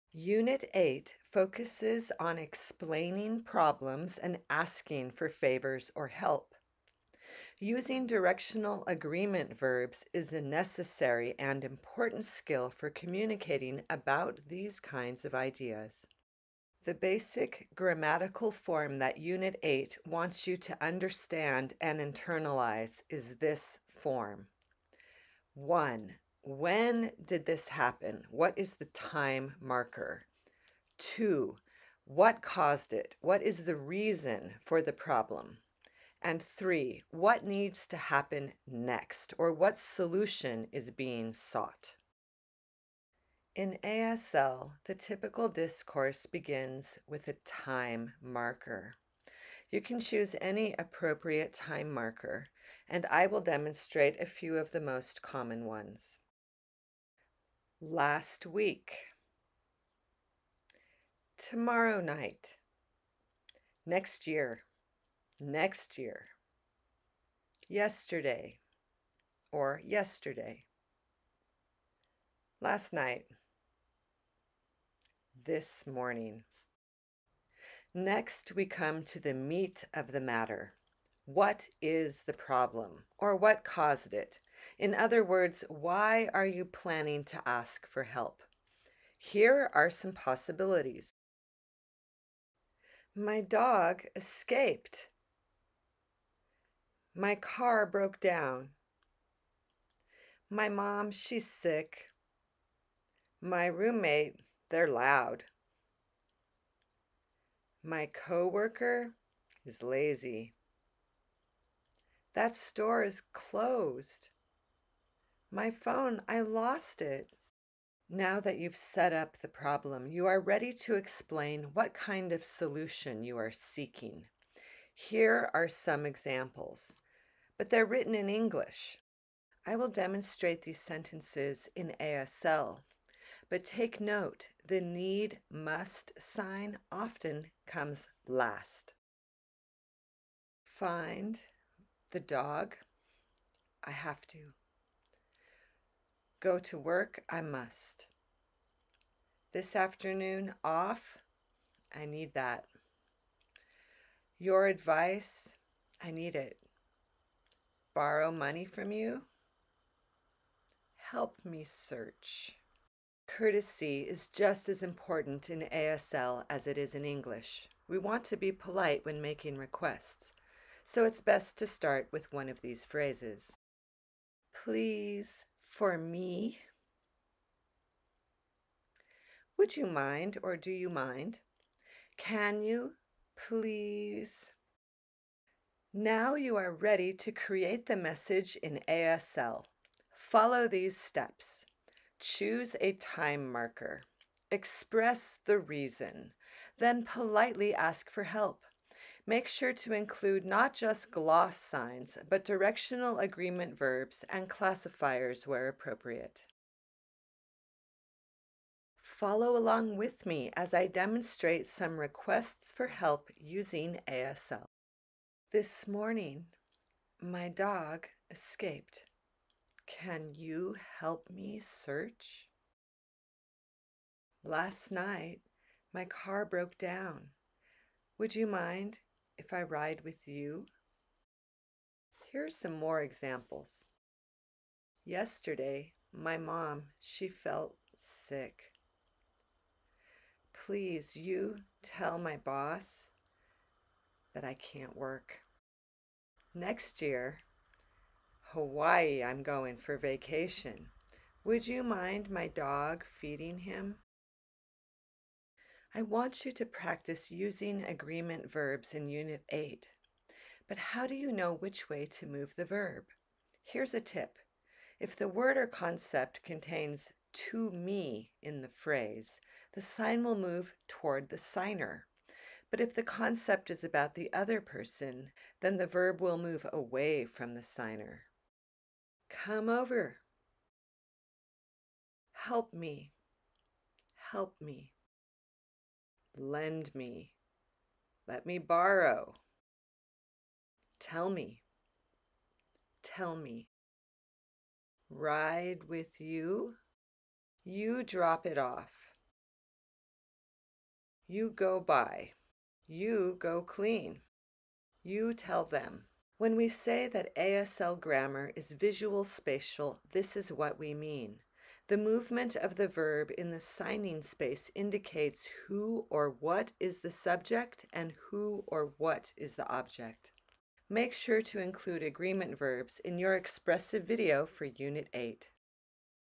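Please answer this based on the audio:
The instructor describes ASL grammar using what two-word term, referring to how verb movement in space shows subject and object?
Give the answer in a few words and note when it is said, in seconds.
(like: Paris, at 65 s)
visual spatial, at 308 s.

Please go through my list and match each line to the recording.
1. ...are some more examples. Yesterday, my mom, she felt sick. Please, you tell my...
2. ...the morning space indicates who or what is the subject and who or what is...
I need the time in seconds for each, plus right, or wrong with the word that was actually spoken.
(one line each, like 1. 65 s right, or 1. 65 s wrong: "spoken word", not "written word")
1. 232 s right
2. 313 s wrong: "signing", not "morning".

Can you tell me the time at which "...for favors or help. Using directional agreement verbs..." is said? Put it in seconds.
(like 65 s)
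5 s.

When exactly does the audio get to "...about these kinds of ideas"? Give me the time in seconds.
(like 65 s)
13 s.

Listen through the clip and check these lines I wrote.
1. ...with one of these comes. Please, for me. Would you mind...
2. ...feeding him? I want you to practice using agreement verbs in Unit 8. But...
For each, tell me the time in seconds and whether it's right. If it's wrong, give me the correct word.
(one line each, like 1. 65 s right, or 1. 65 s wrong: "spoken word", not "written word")
1. 172 s wrong: "phrases", not "comes"
2. 253 s right.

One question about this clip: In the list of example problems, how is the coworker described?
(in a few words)
lazy.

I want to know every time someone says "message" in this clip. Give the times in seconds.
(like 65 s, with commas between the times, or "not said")
187 s.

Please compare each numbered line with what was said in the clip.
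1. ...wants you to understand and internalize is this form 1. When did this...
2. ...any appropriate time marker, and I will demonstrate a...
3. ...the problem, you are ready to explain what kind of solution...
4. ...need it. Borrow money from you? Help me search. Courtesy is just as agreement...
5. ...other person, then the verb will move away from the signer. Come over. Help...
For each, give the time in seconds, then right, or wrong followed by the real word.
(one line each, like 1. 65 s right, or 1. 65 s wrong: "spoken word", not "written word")
1. 20 s right
2. 50 s right
3. 119 s right
4. 156 s wrong: "important", not "agreement"
5. 274 s right.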